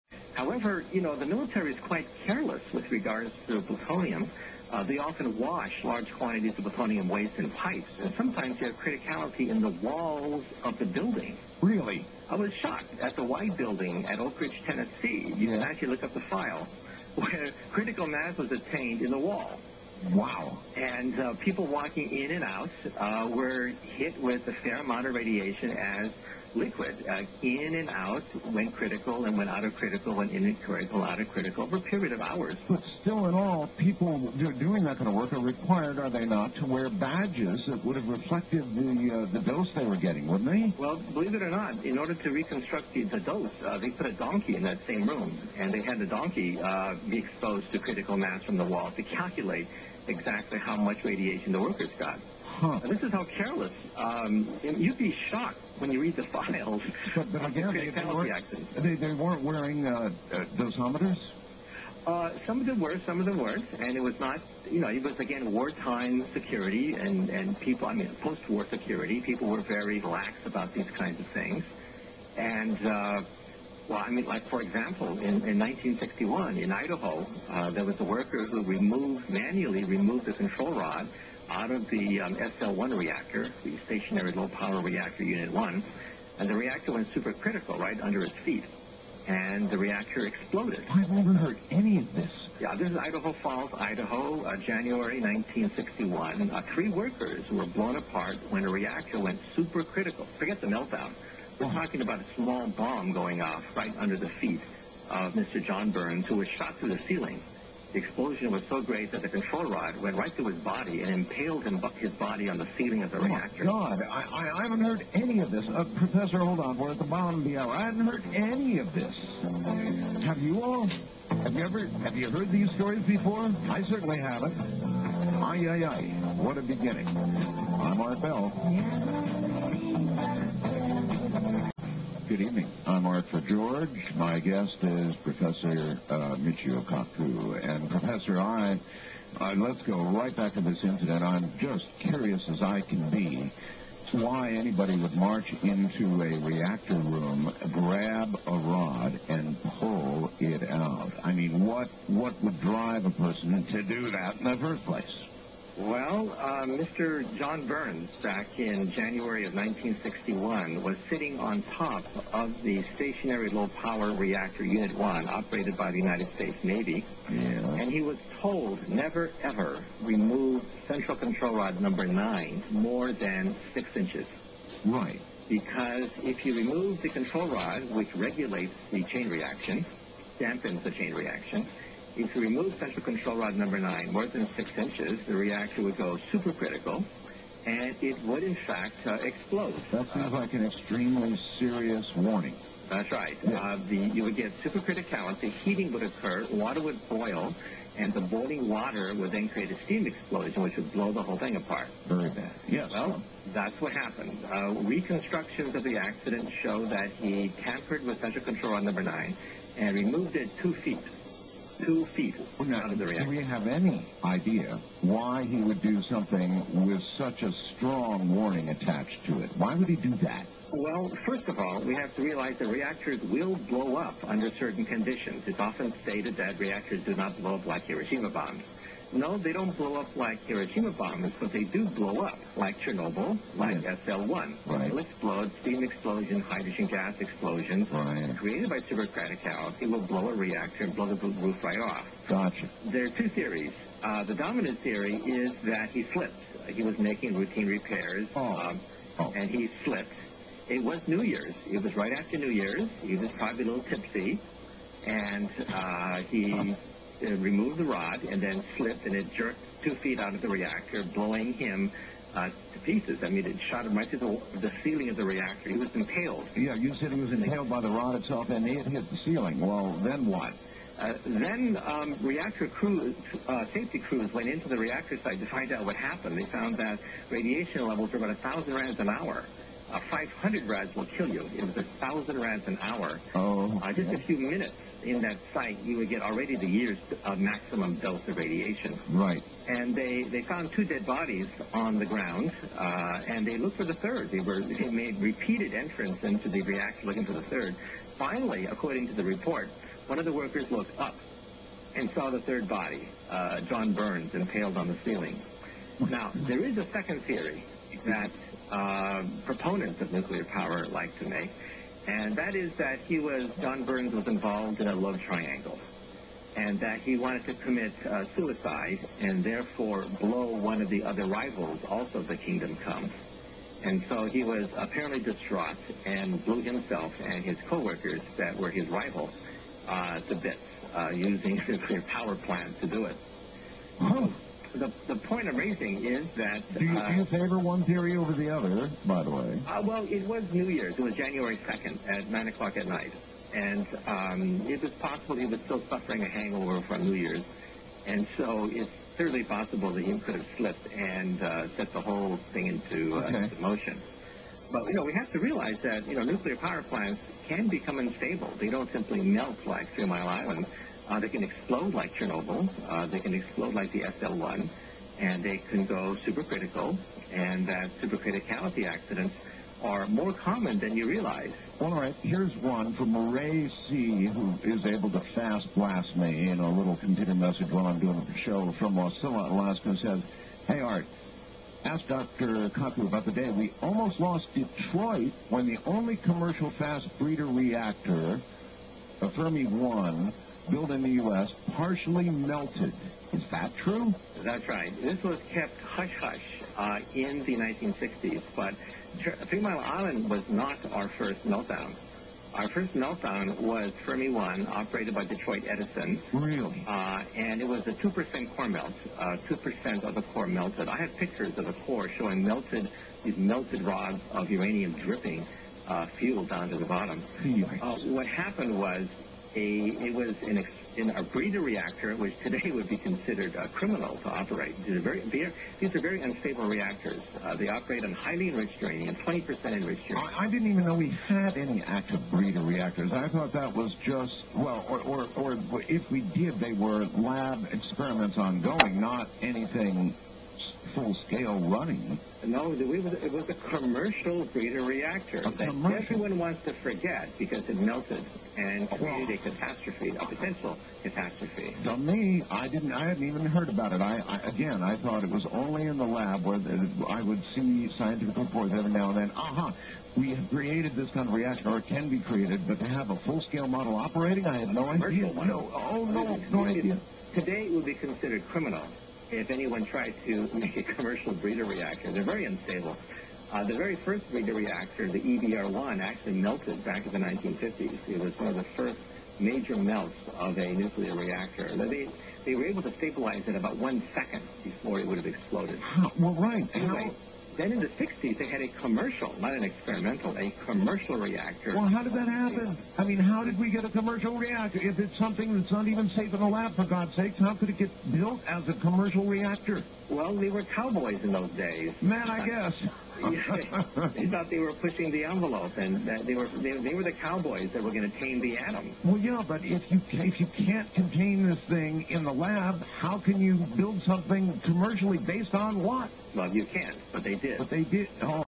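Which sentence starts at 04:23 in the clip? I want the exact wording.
I mean, it shot him right to the, the ceiling of the reactor.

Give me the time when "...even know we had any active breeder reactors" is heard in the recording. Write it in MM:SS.
07:10.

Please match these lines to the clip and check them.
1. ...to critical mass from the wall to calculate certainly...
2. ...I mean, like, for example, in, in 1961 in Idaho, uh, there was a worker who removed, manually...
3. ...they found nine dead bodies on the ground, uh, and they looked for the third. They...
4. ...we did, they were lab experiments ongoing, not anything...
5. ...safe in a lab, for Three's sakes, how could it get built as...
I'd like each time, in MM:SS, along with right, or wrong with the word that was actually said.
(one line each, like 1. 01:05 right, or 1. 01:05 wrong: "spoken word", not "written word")
1. 00:47 wrong: "exactly", not "certainly"
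2. 01:14 right
3. 04:50 wrong: "two", not "nine"
4. 07:16 right
5. 08:16 wrong: "God", not "Three".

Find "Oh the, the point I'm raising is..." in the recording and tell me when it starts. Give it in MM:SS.
05:34.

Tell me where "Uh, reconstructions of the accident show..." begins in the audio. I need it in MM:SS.
03:24.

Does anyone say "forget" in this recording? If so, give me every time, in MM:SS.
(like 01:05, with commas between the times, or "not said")
01:40, 07:26.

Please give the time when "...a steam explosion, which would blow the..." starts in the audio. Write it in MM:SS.
03:19.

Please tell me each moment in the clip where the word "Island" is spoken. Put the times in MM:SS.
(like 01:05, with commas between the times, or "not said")
06:00, 06:39.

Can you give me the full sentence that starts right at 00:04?
Uh, they often wash large quantities of plutonium waste in pipes, and sometimes they have criticality in the walls of the building.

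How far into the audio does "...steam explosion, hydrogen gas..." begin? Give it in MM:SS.
03:55.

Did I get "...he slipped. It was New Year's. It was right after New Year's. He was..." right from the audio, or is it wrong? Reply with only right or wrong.
right.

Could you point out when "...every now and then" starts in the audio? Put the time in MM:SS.
07:38.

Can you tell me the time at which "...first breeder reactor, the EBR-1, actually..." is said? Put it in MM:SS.
07:54.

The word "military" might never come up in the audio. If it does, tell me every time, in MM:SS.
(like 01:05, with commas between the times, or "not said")
00:01.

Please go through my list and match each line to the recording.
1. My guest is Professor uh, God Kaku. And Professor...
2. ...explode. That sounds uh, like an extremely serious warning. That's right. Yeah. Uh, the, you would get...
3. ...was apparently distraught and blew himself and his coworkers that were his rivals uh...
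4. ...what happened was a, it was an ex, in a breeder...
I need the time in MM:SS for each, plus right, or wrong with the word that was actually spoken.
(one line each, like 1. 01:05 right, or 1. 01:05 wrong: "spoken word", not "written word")
1. 02:14 wrong: "Michio", not "God"
2. 03:09 right
3. 05:24 right
4. 06:58 right.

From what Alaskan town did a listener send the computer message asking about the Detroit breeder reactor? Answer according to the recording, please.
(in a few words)
Wasilla, Alaska.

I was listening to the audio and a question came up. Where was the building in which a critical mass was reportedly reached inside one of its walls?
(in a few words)
Oak Ridge, Tennessee.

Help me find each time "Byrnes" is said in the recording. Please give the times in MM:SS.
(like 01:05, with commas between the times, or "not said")
01:45, 02:37, 05:03, 05:13.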